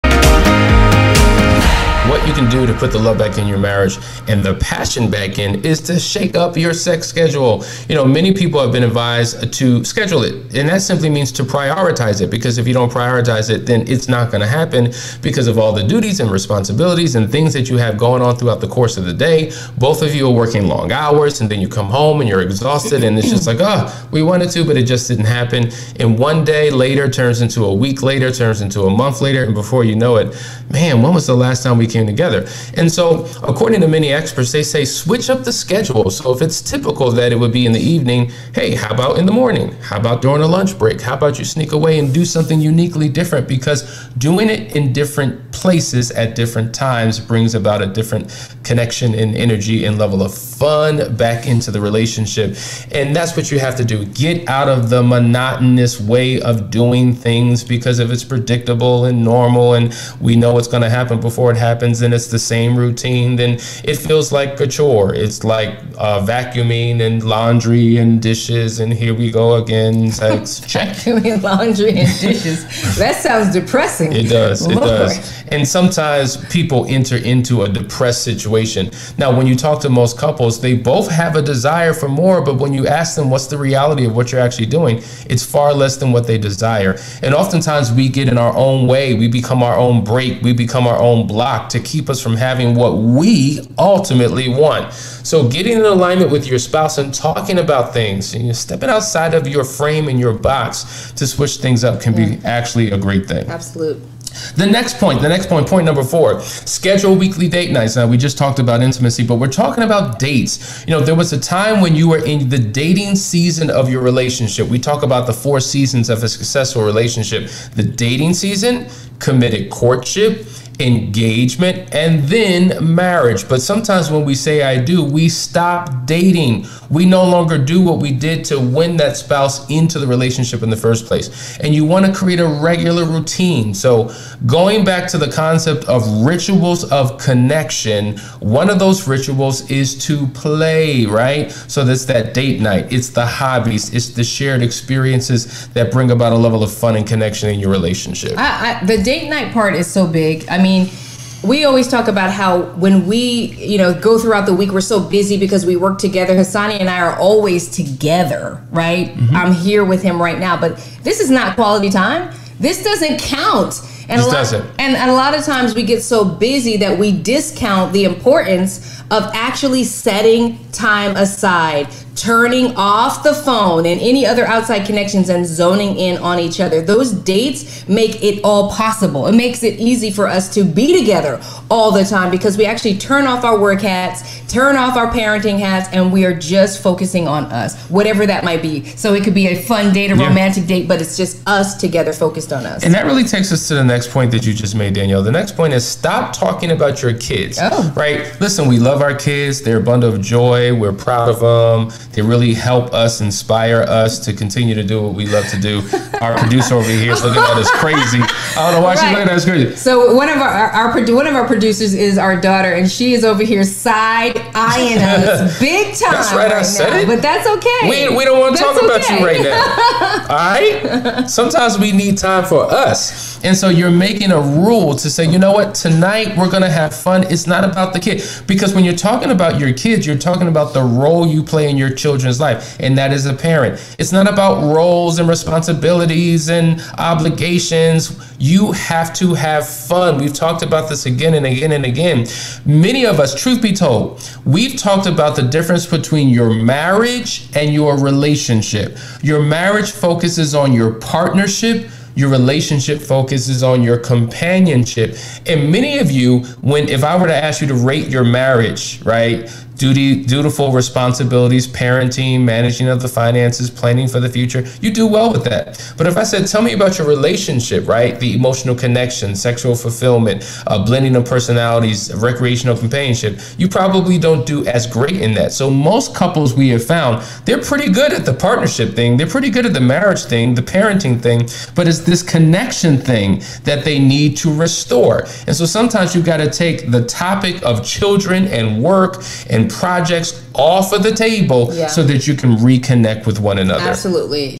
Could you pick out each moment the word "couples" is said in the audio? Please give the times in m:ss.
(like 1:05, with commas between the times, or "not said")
1:20, 4:36.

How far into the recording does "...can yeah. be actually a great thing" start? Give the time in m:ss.
1:42.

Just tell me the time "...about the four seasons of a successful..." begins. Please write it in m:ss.
1:55.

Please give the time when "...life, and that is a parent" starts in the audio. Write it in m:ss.
3:52.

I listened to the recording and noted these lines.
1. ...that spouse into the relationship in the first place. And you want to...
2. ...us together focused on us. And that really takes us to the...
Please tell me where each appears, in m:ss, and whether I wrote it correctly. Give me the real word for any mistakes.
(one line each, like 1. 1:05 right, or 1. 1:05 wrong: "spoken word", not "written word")
1. 2:08 right
2. 3:11 right.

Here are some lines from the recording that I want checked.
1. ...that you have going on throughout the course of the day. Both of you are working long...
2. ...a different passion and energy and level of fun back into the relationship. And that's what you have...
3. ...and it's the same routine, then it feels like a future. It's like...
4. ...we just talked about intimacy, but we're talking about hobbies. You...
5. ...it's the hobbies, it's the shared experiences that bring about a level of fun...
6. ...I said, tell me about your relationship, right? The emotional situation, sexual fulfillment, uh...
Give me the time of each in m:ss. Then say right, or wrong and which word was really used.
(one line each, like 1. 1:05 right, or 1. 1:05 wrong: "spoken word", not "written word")
1. 0:17 right
2. 0:47 wrong: "connection", not "passion"
3. 1:02 wrong: "chore", not "future"
4. 1:48 wrong: "dates", not "hobbies"
5. 2:22 right
6. 4:26 wrong: "connection", not "situation".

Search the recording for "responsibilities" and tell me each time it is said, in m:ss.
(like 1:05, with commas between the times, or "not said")
0:16, 3:55, 4:20.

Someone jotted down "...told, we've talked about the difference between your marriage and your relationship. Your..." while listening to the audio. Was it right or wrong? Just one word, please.
right.